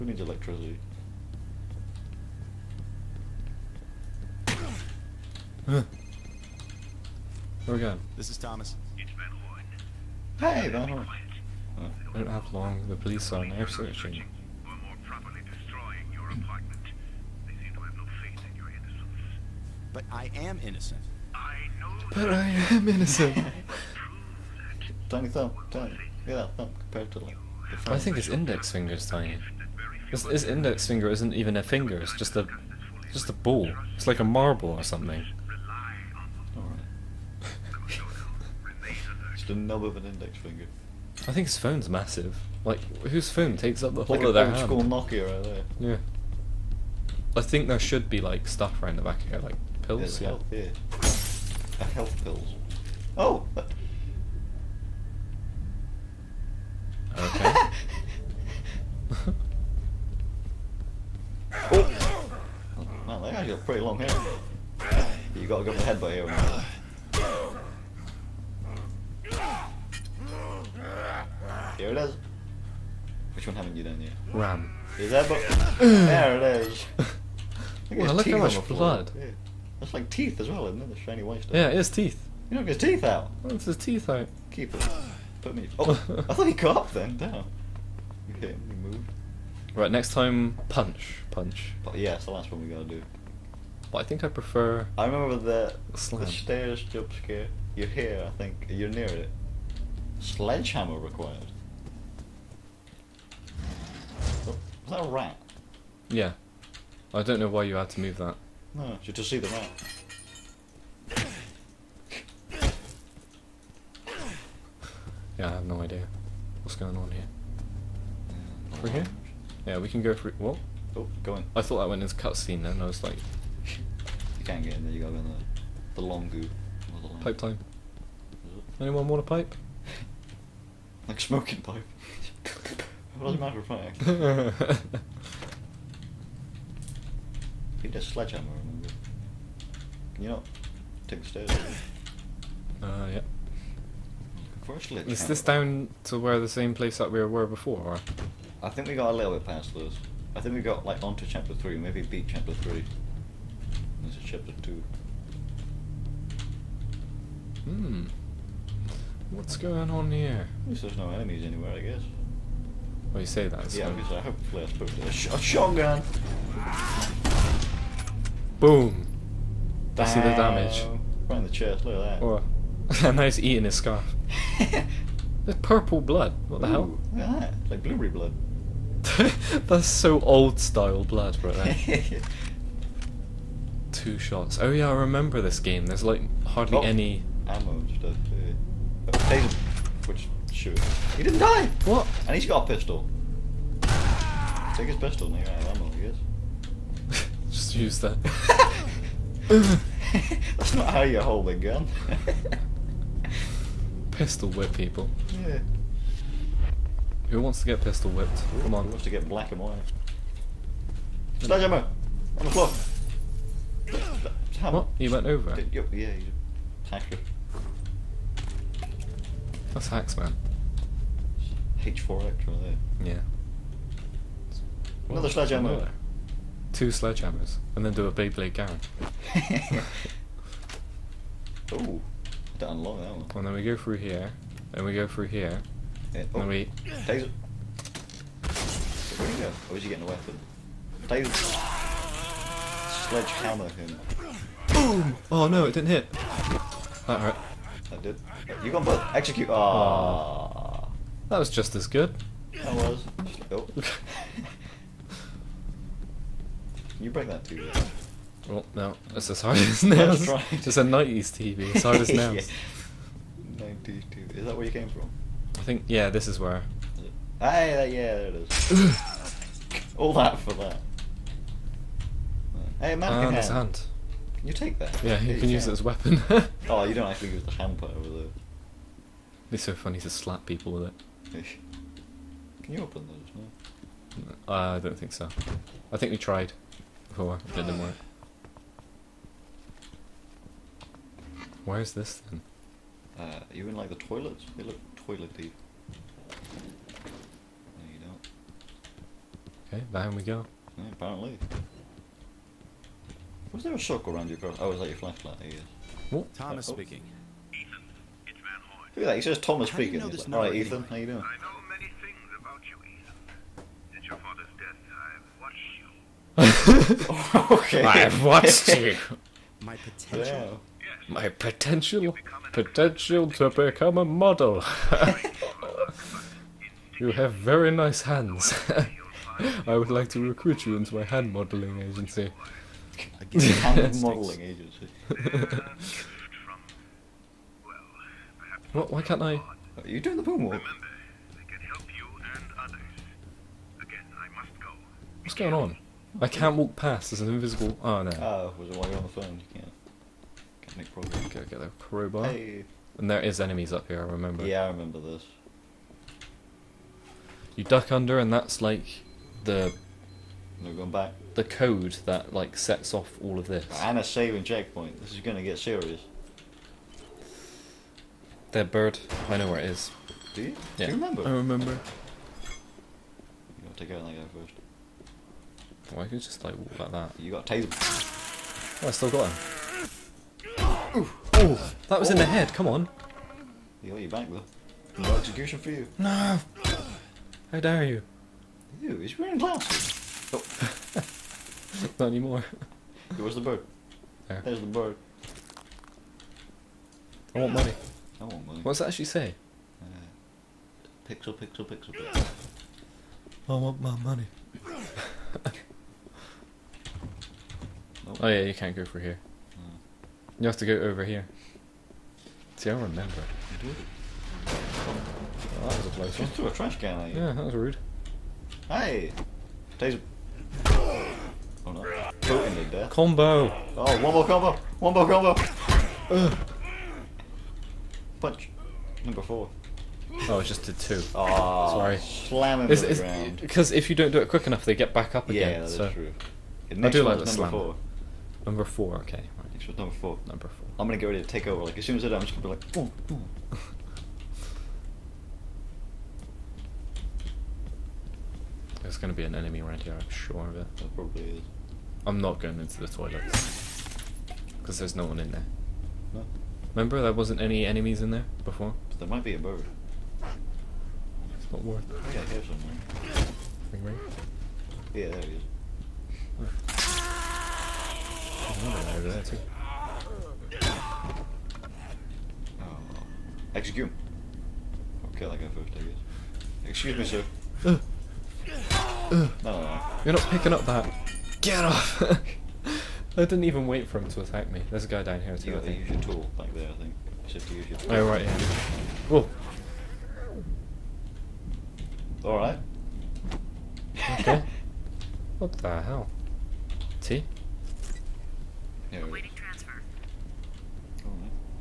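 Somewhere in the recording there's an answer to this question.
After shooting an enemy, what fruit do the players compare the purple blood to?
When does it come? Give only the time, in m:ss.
2:57.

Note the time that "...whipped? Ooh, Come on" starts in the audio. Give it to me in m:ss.
3:28.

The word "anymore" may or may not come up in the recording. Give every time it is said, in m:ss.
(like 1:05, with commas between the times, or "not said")
6:32.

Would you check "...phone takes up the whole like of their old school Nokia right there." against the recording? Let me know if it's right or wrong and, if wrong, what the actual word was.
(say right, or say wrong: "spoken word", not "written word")
right.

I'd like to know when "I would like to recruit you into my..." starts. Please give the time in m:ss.
5:29.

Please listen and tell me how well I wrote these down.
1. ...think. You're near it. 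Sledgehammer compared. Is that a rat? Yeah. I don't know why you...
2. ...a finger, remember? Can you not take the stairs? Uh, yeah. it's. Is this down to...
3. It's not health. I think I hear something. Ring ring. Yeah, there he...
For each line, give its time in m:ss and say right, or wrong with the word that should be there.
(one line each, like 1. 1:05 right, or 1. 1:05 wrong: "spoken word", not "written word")
1. 1:38 wrong: "required", not "compared"
2. 2:17 wrong: "sledgehammer", not "finger"
3. 7:40 wrong: "worth", not "health".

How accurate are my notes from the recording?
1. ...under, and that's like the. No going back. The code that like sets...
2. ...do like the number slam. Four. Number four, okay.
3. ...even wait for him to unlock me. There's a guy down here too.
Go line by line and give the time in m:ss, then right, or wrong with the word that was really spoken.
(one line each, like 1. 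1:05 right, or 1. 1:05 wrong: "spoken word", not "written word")
1. 5:57 right
2. 7:16 right
3. 8:03 wrong: "attack", not "unlock".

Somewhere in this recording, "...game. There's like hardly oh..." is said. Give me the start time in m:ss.
3:05.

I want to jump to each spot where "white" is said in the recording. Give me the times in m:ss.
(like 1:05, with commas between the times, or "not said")
1:21, 3:29.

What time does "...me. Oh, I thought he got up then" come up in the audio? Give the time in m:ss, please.
1:25.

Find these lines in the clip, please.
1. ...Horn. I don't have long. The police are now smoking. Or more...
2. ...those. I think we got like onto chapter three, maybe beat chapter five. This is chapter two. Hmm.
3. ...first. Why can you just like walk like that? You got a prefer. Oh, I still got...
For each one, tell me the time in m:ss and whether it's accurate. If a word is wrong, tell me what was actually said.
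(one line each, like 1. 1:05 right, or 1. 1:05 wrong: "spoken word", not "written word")
1. 0:10 wrong: "searching", not "smoking"
2. 2:29 wrong: "three", not "five"
3. 6:14 wrong: "taser", not "prefer".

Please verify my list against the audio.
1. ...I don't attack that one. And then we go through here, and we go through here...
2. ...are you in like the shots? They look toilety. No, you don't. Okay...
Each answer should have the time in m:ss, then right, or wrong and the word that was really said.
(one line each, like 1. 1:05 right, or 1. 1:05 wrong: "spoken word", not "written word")
1. 3:51 wrong: "unlock", not "attack"
2. 4:53 wrong: "toilets", not "shots".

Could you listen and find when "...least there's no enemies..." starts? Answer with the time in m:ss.
2:40.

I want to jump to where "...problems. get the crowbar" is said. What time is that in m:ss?
5:50.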